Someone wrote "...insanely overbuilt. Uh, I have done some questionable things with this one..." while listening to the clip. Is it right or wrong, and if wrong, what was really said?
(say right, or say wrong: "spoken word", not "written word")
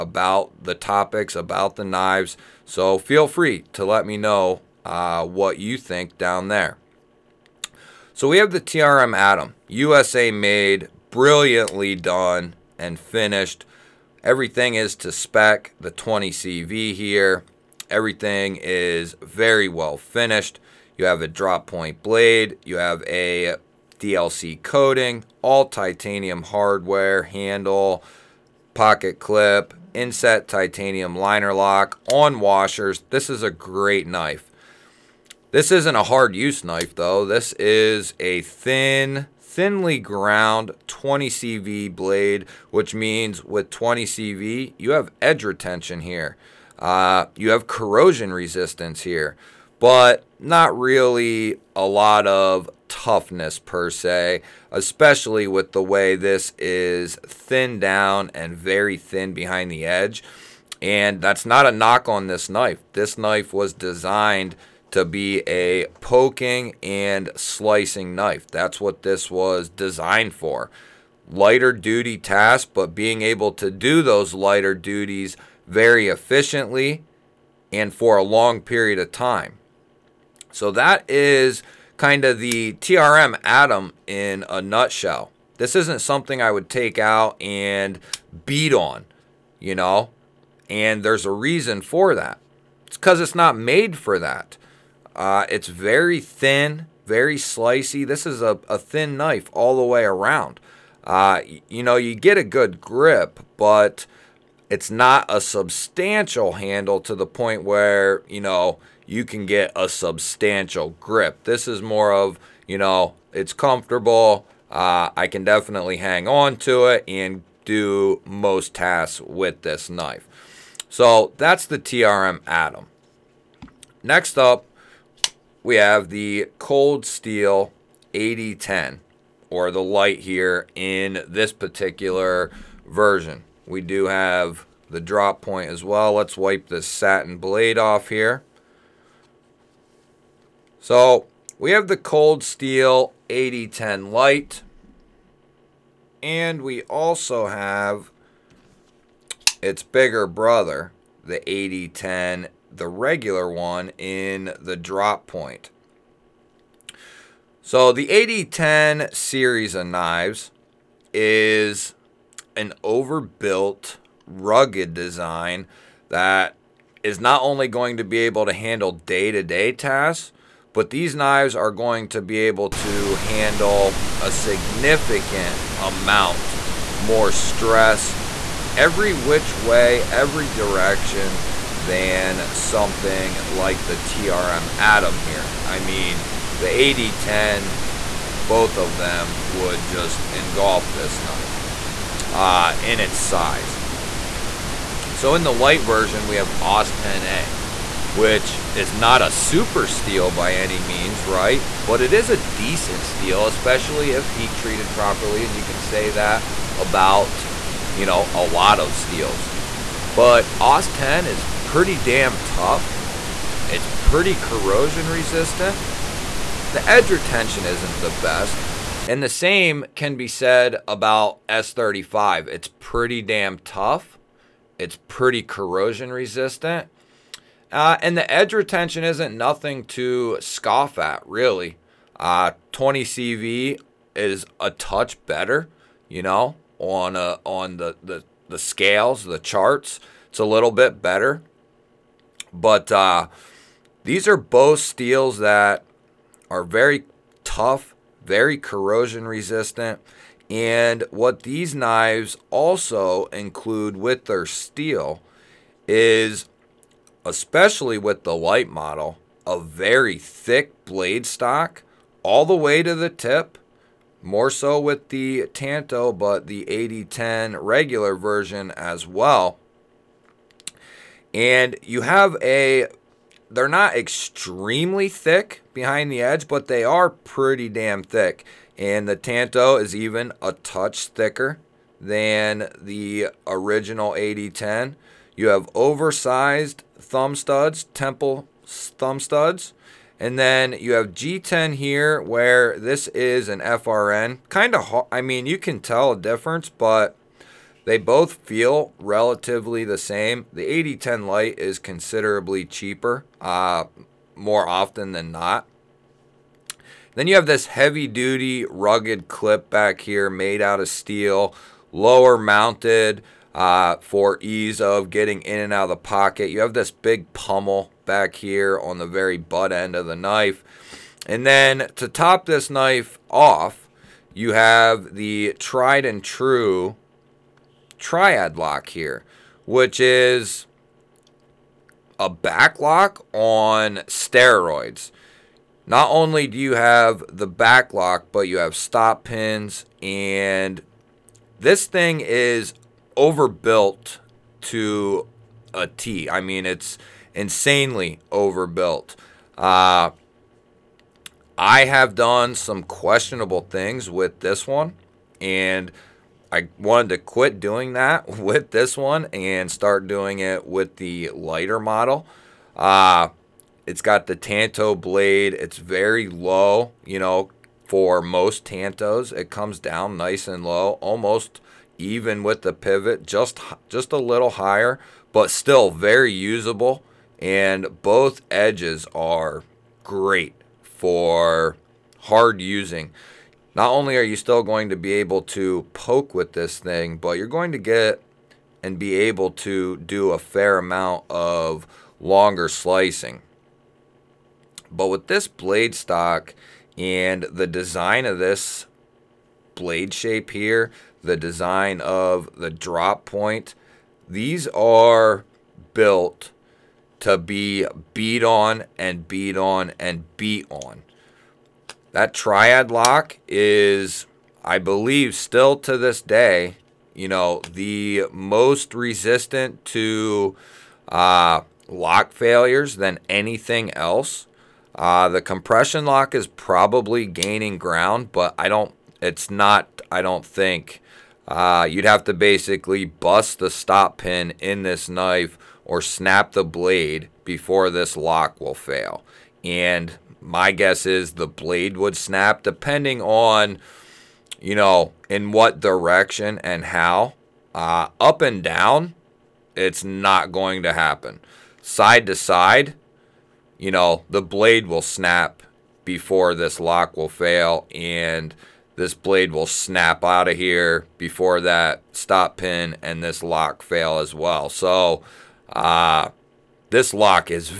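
right.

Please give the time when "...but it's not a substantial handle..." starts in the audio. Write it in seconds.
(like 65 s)
103 s.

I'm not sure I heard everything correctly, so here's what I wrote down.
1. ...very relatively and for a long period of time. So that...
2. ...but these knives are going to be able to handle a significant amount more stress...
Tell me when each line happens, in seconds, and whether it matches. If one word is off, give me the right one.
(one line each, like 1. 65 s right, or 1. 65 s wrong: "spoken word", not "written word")
1. 75 s wrong: "efficiently", not "relatively"
2. 170 s right.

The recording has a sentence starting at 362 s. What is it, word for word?
Uh, it's got the Tanto blade.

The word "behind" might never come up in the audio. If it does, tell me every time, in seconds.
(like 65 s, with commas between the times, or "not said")
59 s, 275 s.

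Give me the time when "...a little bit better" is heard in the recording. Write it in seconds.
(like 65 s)
240 s.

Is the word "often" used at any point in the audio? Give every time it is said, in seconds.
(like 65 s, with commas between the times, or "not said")
304 s.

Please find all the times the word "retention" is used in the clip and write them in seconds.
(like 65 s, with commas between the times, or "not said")
45 s, 217 s, 228 s.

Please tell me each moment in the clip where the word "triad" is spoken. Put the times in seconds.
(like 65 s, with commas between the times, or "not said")
327 s, 412 s.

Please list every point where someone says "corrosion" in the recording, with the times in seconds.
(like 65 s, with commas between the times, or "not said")
47 s, 214 s, 225 s, 248 s.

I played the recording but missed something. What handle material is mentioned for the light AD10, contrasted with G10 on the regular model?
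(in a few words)
FRN.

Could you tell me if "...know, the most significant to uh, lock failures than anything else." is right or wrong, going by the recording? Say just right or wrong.
wrong.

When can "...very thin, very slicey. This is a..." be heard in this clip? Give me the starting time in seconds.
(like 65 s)
95 s.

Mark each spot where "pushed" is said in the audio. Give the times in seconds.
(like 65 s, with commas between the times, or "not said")
not said.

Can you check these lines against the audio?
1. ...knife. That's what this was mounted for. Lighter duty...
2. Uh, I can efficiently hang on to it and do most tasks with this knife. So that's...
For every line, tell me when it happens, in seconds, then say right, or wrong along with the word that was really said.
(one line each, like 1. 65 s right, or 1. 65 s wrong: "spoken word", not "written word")
1. 68 s wrong: "designed", not "mounted"
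2. 114 s wrong: "definitely", not "efficiently".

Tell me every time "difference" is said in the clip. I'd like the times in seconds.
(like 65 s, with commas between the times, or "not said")
296 s.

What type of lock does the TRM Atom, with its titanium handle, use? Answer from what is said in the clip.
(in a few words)
liner lock.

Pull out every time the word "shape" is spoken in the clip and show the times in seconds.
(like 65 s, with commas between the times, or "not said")
400 s.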